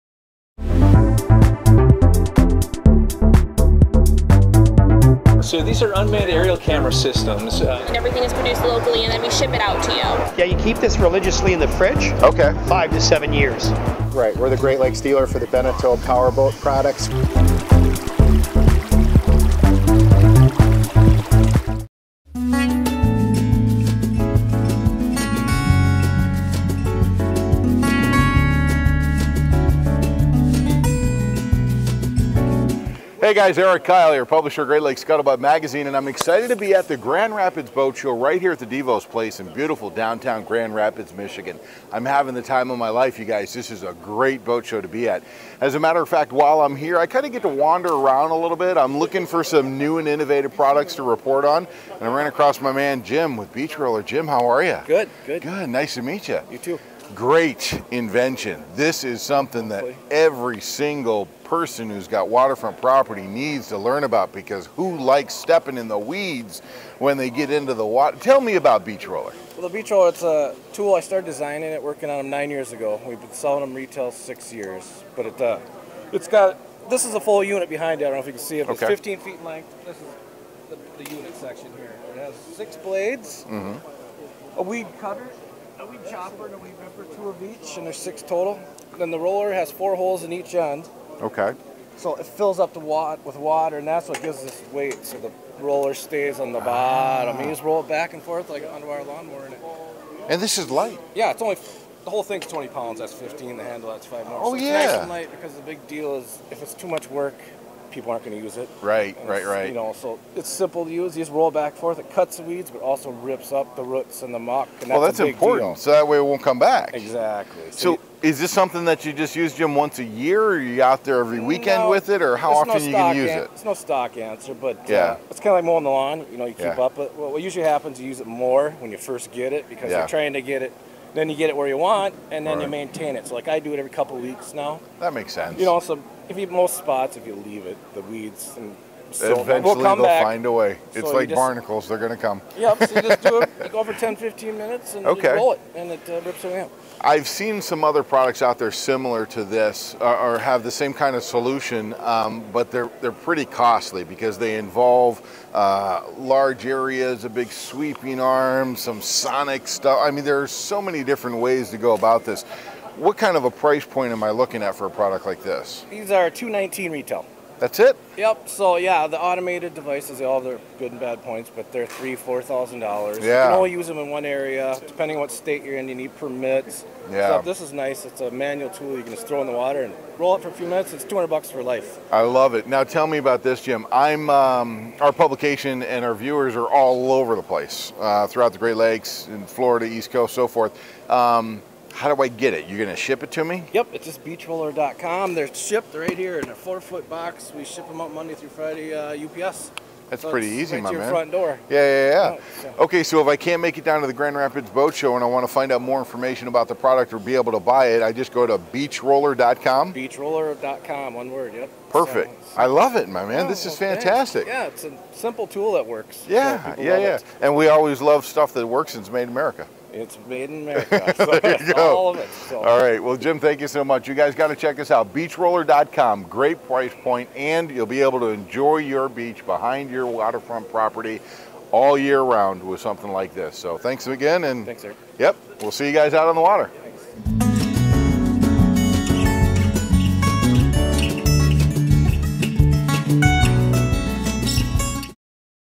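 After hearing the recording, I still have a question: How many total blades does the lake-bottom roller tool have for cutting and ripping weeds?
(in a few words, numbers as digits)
6.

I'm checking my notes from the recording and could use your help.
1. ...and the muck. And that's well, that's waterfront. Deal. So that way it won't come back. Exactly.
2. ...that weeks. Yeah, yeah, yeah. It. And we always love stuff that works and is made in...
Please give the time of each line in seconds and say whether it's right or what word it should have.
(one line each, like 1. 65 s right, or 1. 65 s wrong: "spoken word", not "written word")
1. 114 s wrong: "important", not "waterfront"
2. 215 s wrong: "works", not "weeks".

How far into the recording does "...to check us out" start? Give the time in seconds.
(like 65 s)
224 s.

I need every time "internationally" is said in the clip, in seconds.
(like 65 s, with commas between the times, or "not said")
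not said.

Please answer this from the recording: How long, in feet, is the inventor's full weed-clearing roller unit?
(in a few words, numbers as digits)
15 feet.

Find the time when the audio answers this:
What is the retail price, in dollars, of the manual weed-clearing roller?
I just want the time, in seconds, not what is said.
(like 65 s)
166 s.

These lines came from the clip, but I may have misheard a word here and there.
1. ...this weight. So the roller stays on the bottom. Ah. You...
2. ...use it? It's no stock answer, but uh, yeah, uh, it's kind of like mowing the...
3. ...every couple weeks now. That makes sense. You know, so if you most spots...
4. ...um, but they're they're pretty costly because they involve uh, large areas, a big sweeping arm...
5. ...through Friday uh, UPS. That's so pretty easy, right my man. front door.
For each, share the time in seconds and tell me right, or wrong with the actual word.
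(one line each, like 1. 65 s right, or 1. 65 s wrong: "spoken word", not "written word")
1. 94 s right
2. 123 s right
3. 133 s right
4. 151 s right
5. 198 s right.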